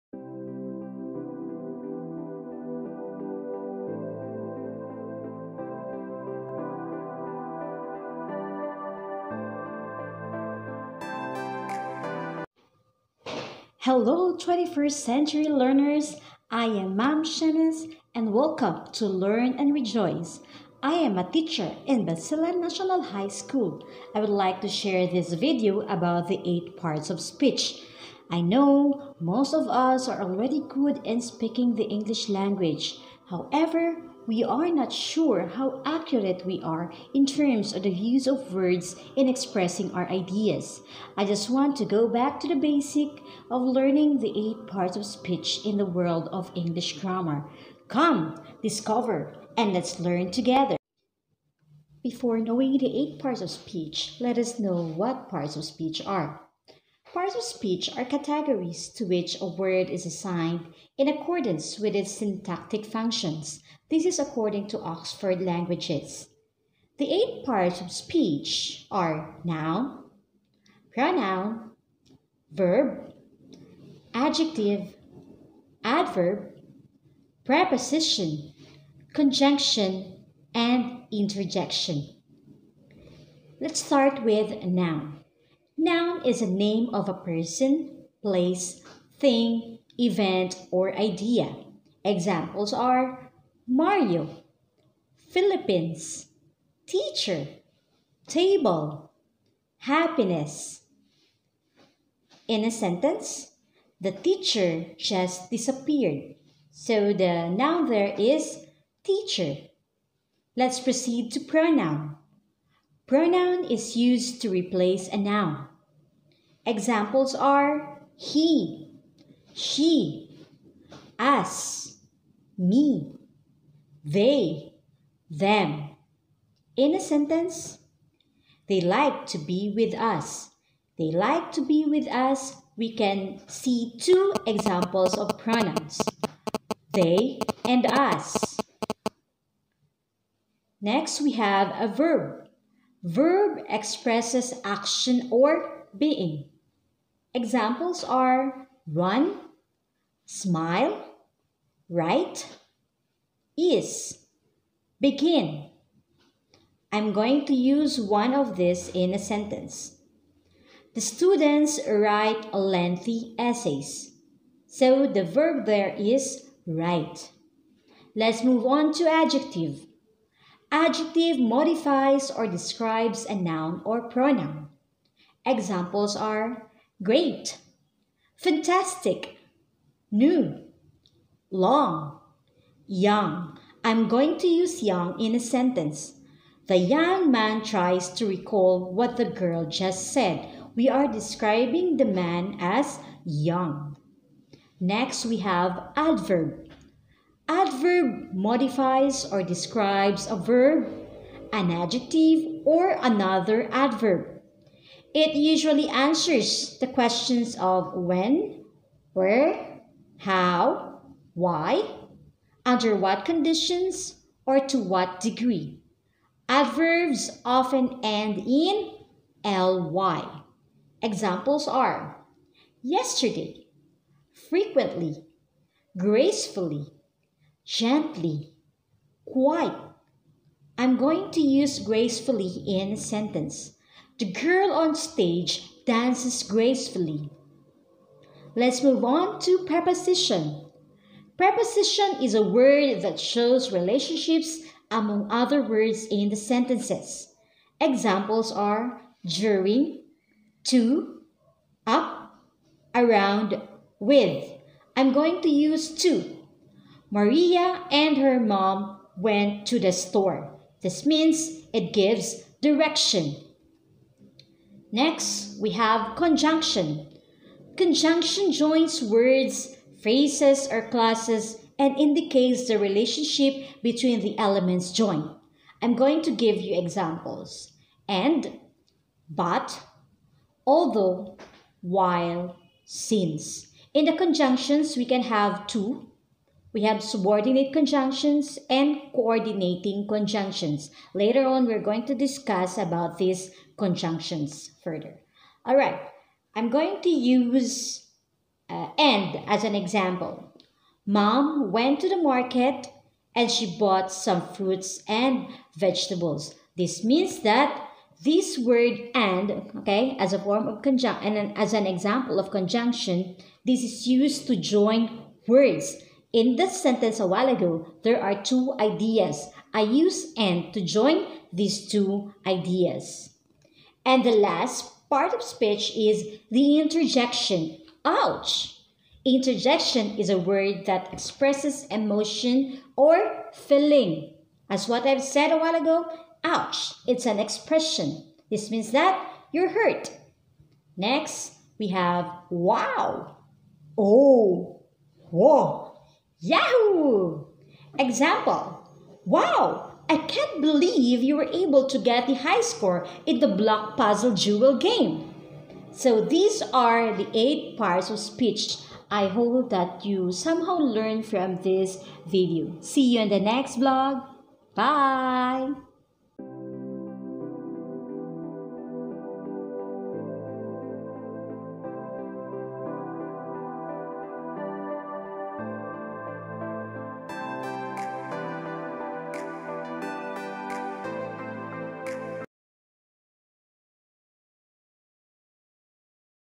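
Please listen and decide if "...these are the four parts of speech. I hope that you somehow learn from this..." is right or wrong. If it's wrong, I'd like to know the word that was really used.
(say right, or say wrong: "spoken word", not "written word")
wrong: "eight", not "four".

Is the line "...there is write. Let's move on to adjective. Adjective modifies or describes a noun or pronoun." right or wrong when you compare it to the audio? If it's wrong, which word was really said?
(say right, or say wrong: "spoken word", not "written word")
right.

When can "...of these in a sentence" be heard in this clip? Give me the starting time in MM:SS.
02:38.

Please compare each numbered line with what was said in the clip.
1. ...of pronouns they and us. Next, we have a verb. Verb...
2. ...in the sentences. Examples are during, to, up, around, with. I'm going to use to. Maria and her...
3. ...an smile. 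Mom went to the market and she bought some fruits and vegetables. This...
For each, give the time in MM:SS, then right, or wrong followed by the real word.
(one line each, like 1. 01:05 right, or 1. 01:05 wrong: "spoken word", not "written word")
1. 02:15 right
2. 04:06 right
3. 04:59 wrong: "example", not "smile".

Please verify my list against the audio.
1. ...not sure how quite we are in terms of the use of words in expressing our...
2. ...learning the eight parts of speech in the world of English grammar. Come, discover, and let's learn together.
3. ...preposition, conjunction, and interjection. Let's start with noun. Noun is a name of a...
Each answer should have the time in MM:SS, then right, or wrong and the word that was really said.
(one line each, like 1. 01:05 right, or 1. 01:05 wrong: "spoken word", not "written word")
1. 00:34 wrong: "accurate", not "quite"
2. 00:43 right
3. 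01:17 right.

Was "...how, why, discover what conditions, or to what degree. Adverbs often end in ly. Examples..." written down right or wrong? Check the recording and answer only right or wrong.
wrong.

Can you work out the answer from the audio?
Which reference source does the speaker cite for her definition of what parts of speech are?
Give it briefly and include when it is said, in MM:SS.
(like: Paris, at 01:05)
Oxford Languages, at 01:04.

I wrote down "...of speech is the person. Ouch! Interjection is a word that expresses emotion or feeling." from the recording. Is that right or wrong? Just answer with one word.
wrong.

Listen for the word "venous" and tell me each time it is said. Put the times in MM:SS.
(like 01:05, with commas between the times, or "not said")
not said.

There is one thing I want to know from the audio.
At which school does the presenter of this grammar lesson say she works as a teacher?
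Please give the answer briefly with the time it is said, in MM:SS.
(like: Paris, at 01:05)
Basilan National High School, at 00:22.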